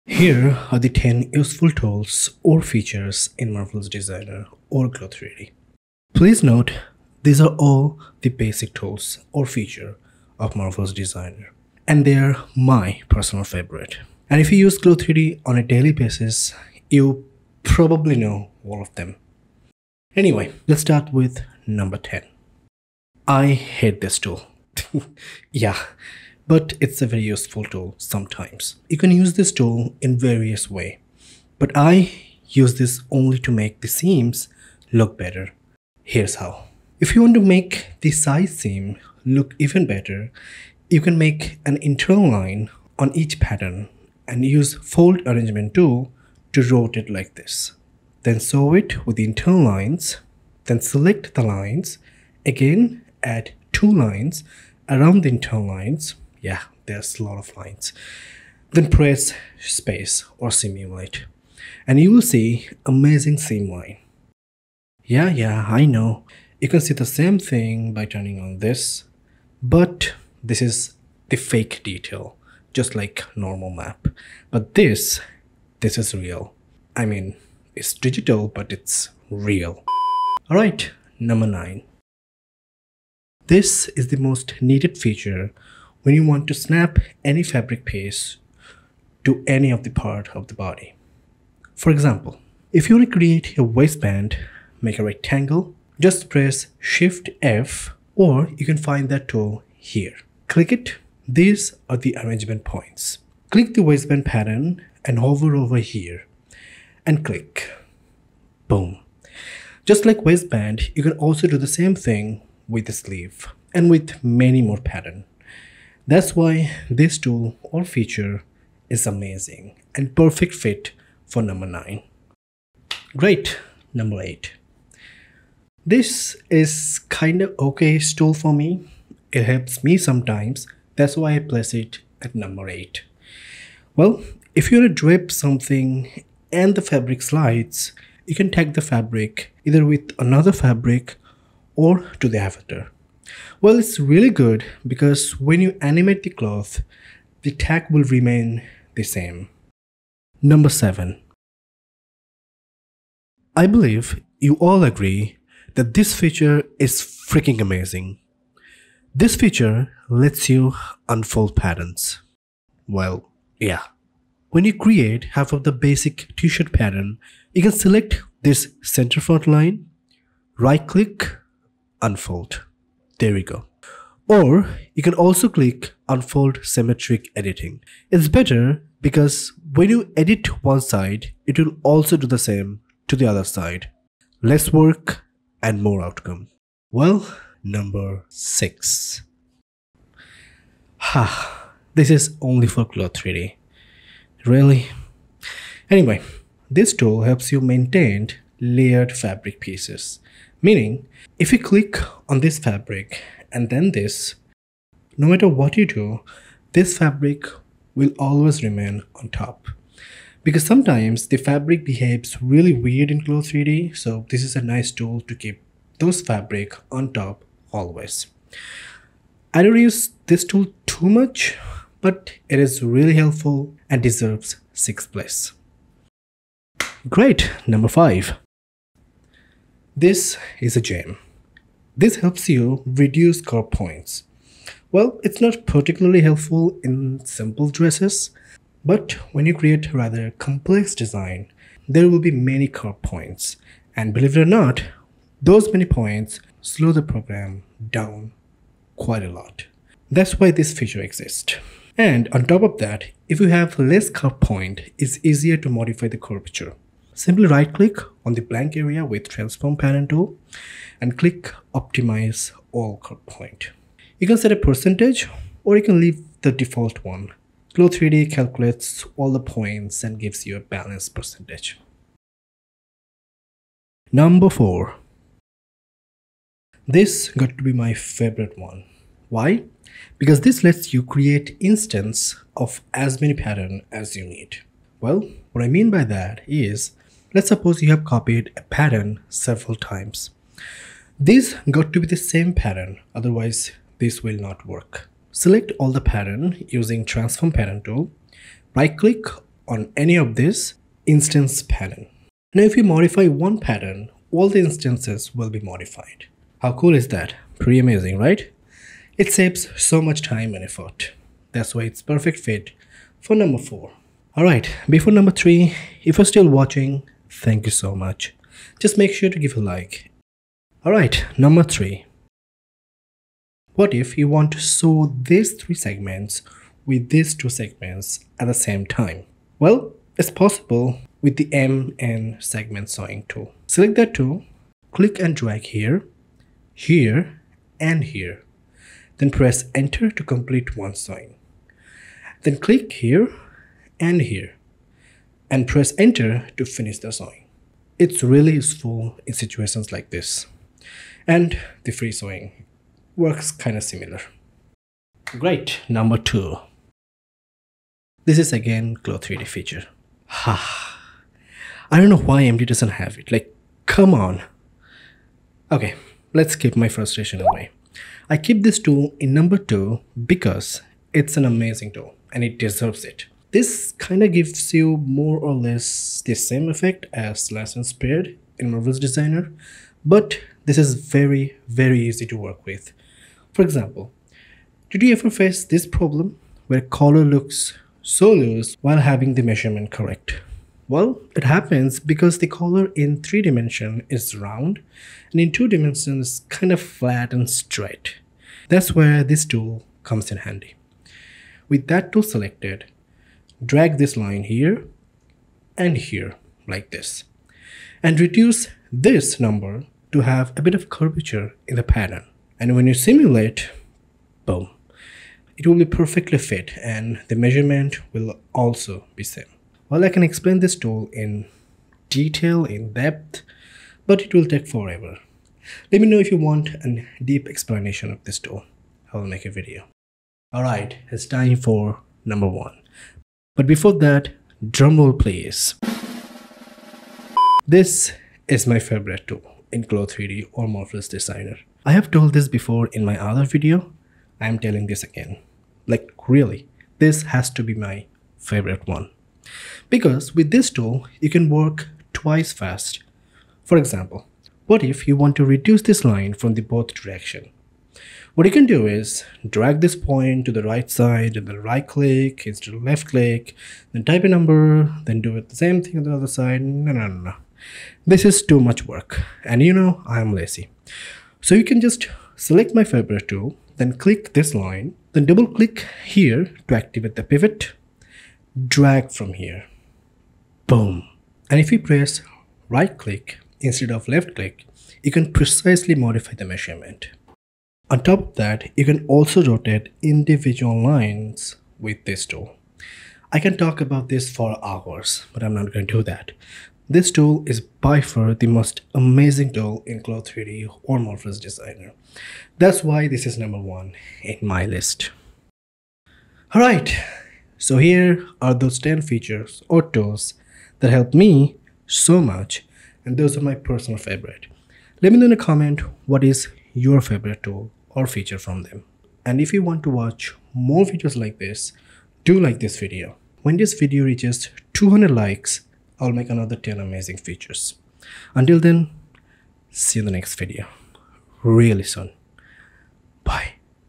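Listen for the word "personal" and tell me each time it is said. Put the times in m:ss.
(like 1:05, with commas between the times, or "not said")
0:13, 8:33.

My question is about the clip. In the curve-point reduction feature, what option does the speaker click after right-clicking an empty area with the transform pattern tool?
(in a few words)
optimize all point.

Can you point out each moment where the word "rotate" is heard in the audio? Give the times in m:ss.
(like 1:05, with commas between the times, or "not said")
0:46, 8:09.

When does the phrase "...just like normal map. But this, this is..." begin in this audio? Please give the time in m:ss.
1:12.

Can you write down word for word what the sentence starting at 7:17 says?
This is my favorite tool in CLO 3D or Marvelous Designer.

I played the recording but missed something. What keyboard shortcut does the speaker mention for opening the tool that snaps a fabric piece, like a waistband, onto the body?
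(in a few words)
Shift F.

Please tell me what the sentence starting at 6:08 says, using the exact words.
I keep this tool in number two because it's an amazing tool and it deserves it.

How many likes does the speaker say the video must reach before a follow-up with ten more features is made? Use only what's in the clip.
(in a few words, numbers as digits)
200.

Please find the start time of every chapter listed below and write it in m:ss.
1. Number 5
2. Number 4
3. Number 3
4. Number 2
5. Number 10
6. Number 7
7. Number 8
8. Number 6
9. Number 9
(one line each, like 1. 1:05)
1. 3:46
2. 4:34
3. 5:20
4. 5:55
5. 0:20
6. 2:30
7. 2:03
8. 3:07
9. 1:21.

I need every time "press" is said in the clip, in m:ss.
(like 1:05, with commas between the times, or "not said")
0:58, 1:36, 5:39, 5:45, 8:01.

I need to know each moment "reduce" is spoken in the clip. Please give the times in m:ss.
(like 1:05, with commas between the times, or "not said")
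3:52, 6:48, 7:35.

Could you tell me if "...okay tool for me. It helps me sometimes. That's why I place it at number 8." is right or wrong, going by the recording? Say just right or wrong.
right.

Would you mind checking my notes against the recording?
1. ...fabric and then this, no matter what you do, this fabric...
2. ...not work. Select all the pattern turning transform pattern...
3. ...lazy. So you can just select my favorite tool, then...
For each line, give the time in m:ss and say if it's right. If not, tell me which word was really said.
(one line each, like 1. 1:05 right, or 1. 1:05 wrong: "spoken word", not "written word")
1. 3:22 right
2. 4:54 wrong: "using", not "turning"
3. 7:50 right.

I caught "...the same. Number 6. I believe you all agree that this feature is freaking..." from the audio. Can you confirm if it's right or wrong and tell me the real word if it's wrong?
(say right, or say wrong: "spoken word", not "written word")
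wrong: "7", not "6".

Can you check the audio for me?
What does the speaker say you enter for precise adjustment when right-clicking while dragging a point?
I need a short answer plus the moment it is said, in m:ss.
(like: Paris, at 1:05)
a number, at 7:44.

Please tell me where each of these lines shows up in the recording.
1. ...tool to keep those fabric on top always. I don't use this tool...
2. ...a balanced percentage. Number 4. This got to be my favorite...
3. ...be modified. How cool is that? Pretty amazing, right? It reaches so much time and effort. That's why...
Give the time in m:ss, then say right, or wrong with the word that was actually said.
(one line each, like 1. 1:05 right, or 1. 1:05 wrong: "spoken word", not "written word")
1. 3:34 right
2. 4:30 right
3. 5:05 wrong: "saves", not "reaches".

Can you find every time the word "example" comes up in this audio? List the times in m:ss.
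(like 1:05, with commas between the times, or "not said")
1:31, 6:23, 7:33.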